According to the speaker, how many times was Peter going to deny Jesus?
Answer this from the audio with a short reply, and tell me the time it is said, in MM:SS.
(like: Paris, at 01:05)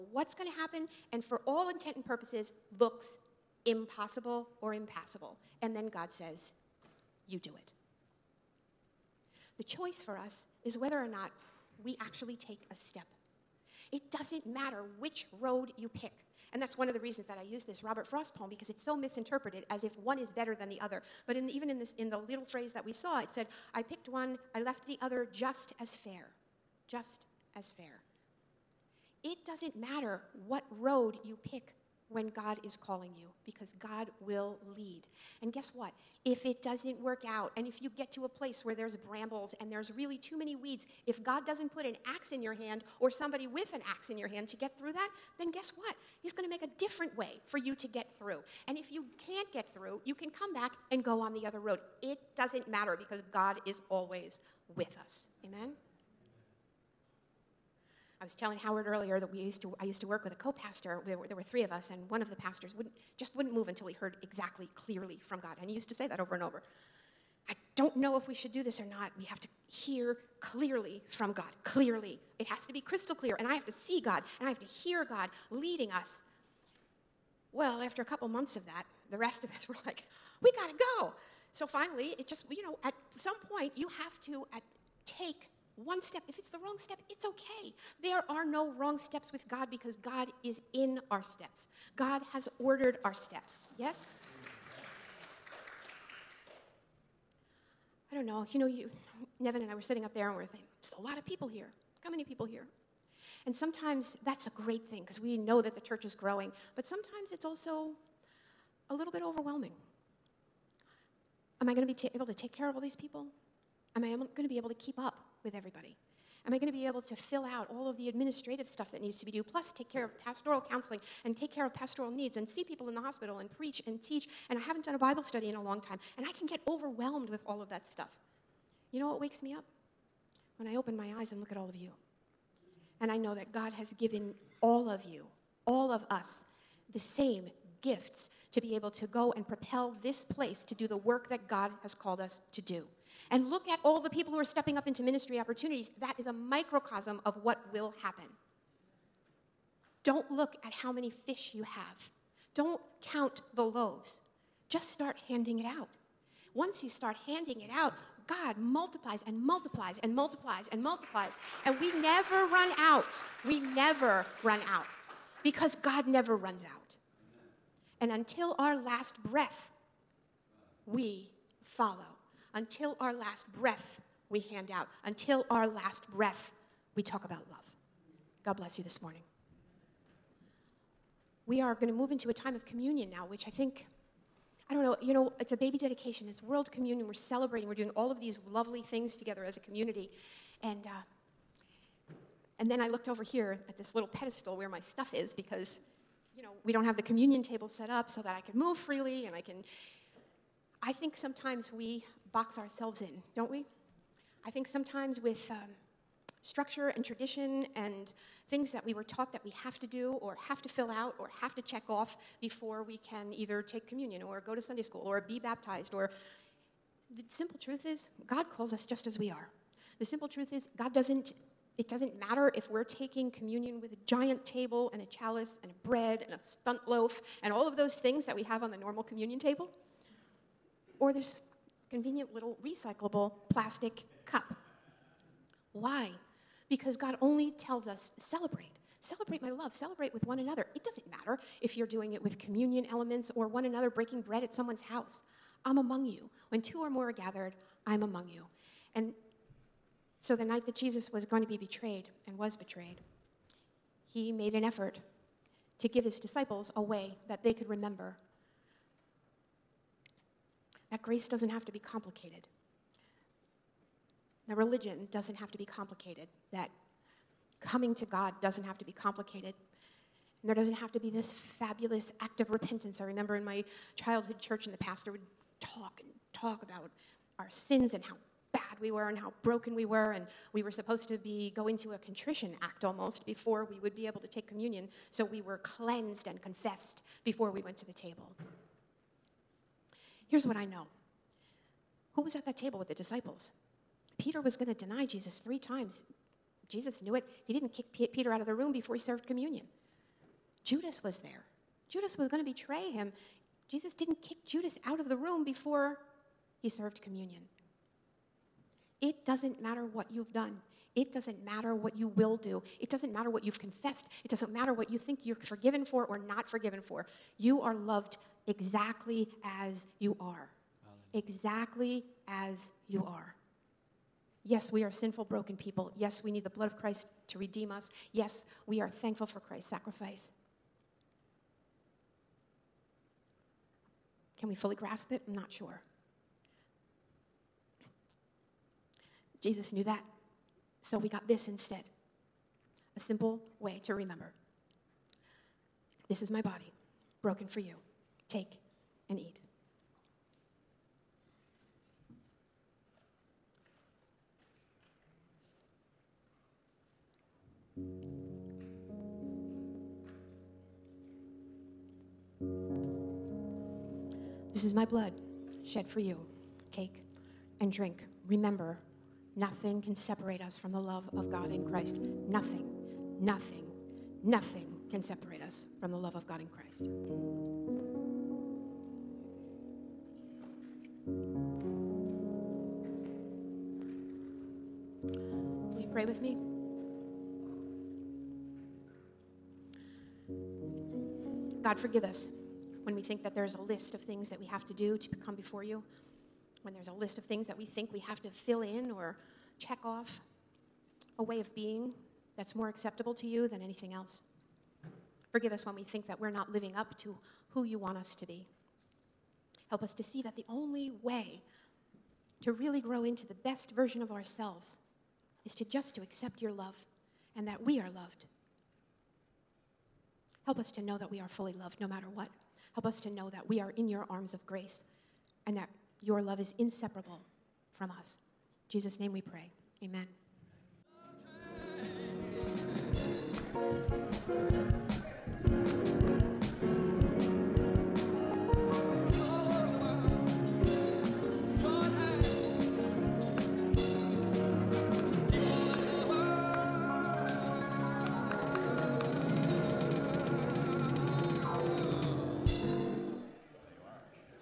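3, at 04:55.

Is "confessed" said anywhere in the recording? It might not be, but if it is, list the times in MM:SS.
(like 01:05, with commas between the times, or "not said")
04:46, 05:13.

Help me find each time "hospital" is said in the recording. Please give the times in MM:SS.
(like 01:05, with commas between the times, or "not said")
02:02.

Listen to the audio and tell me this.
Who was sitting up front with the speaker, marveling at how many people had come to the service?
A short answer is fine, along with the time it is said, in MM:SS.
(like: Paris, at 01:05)
Nevin, at 01:39.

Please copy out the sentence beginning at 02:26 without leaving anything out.
That is a microcosm of what will happen.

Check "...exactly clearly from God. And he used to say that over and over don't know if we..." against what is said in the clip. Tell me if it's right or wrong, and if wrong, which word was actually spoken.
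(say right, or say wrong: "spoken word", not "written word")
right.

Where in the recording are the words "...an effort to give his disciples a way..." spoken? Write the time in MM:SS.
04:14.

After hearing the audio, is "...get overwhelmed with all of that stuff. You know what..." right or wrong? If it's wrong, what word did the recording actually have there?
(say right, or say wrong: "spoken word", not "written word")
right.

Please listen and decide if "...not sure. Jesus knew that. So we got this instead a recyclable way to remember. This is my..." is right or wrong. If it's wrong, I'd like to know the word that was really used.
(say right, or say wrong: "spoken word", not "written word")
wrong: "simple", not "recyclable".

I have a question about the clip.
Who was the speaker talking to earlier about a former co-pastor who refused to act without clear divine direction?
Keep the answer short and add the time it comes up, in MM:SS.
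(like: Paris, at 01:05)
Howard, at 00:58.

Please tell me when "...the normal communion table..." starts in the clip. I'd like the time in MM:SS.
03:48.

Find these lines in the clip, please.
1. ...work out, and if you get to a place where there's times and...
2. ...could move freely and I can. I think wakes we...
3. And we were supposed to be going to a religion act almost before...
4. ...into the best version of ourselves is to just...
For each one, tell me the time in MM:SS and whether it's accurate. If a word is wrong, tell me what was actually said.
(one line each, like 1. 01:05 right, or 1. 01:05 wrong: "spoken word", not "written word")
1. 00:36 wrong: "brambles", not "times"
2. 03:18 wrong: "sometimes", not "wakes"
3. 04:40 wrong: "contrition", not "religion"
4. 06:53 right.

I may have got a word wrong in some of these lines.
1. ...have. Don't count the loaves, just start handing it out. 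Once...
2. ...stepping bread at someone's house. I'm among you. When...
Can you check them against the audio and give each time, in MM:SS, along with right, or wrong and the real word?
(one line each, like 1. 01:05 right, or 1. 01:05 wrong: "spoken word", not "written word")
1. 02:31 right
2. 04:03 wrong: "breaking", not "stepping".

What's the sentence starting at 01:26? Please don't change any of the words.
If it's the wrong step, it's okay.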